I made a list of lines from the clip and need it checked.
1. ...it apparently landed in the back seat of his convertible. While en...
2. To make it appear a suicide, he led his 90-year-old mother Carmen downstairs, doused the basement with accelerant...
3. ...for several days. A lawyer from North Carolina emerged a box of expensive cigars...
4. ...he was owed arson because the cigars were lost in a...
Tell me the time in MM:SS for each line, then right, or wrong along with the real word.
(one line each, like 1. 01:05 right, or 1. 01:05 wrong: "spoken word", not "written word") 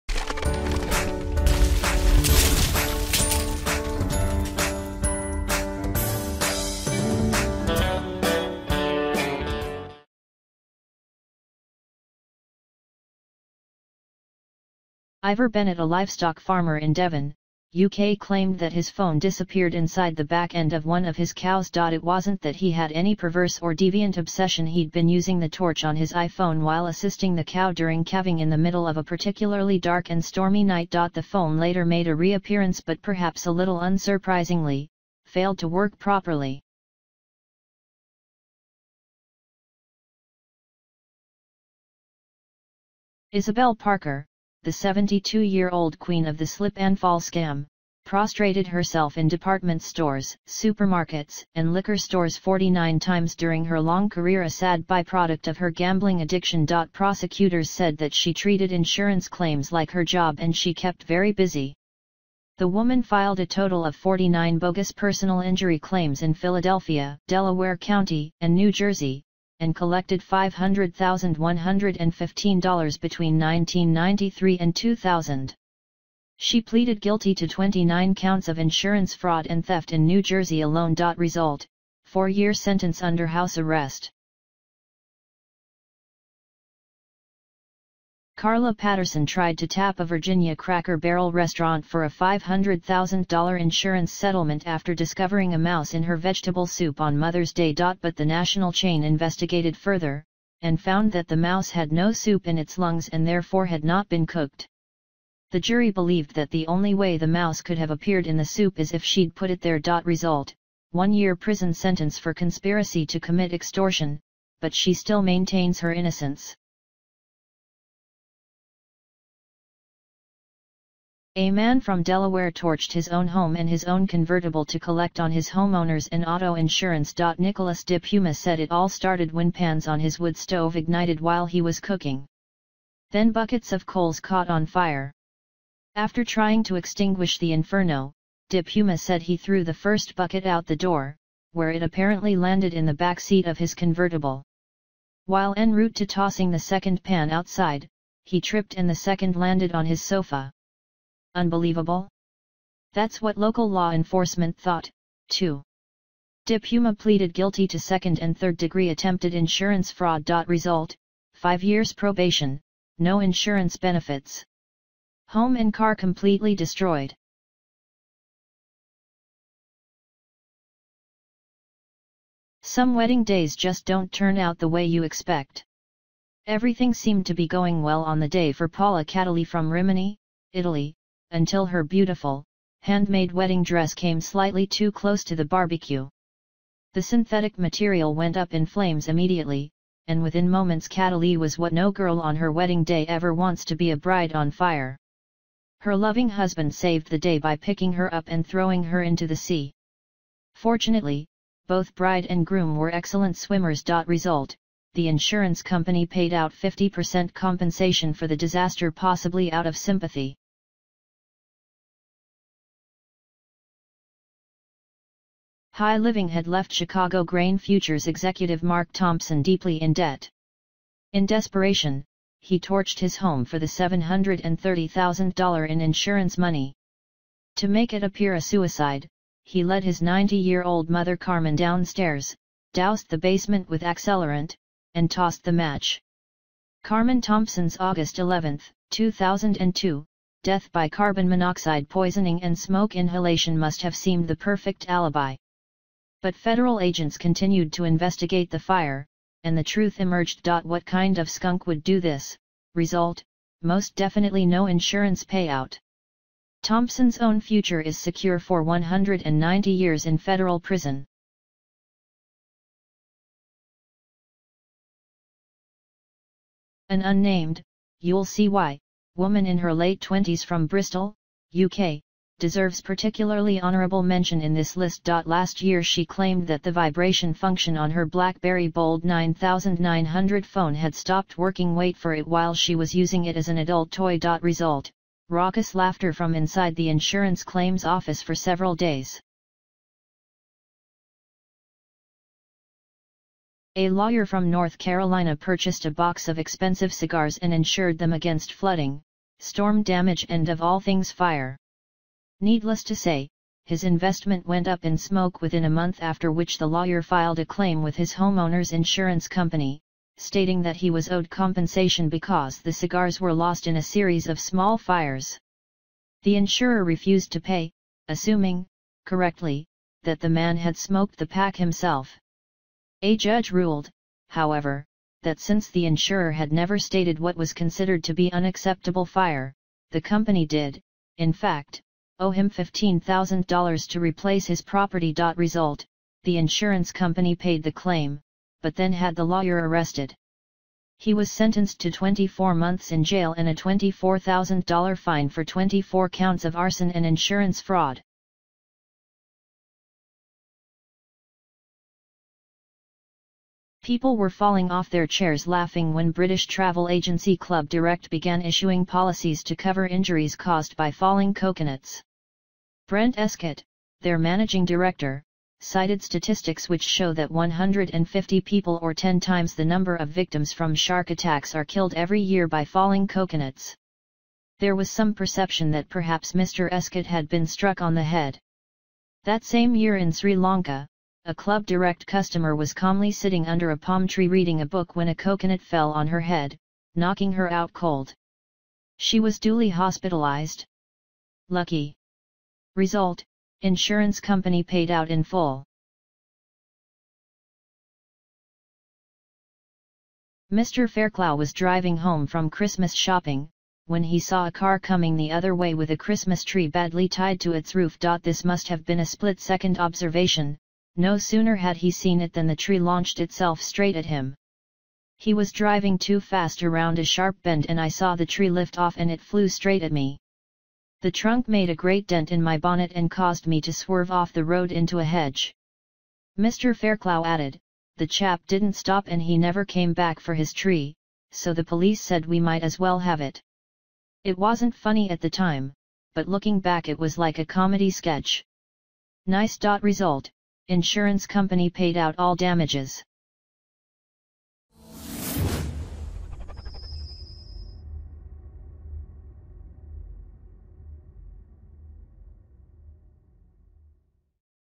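1. 02:21 right
2. 03:47 right
3. 04:48 wrong: "purchased", not "emerged"
4. 05:10 wrong: "compensation", not "arson".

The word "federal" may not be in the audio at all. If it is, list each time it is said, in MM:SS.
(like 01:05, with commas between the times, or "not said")
04:06, 04:20.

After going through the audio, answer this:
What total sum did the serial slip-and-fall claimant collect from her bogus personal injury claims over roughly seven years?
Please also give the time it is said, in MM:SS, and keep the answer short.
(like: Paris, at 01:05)
$500,115, at 01:10.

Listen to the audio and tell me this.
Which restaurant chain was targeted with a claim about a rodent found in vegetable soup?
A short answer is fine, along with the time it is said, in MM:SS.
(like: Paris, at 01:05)
Cracker Barrel, at 01:30.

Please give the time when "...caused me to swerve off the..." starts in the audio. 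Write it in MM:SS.
07:03.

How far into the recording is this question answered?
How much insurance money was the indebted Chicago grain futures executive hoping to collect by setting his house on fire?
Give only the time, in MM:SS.
03:43.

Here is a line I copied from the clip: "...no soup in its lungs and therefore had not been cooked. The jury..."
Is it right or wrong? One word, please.
right.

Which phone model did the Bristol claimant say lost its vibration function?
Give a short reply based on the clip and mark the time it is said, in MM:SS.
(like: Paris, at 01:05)
BlackBerry Bold 9900, at 04:38.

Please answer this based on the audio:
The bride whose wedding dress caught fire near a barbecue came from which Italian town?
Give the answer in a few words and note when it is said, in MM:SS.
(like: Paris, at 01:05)
Rimini, at 02:59.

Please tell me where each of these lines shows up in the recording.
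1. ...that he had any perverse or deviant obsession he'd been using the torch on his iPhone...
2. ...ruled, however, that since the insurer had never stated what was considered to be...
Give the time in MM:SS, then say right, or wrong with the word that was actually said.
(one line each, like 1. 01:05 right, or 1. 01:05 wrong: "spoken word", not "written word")
1. 00:22 right
2. 05:23 right.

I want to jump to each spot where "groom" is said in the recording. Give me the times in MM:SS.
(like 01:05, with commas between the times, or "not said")
03:22.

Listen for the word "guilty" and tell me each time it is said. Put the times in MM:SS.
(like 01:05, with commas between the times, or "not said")
01:16, 02:37.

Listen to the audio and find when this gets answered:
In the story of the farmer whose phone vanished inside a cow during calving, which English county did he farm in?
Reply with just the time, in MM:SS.
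00:16.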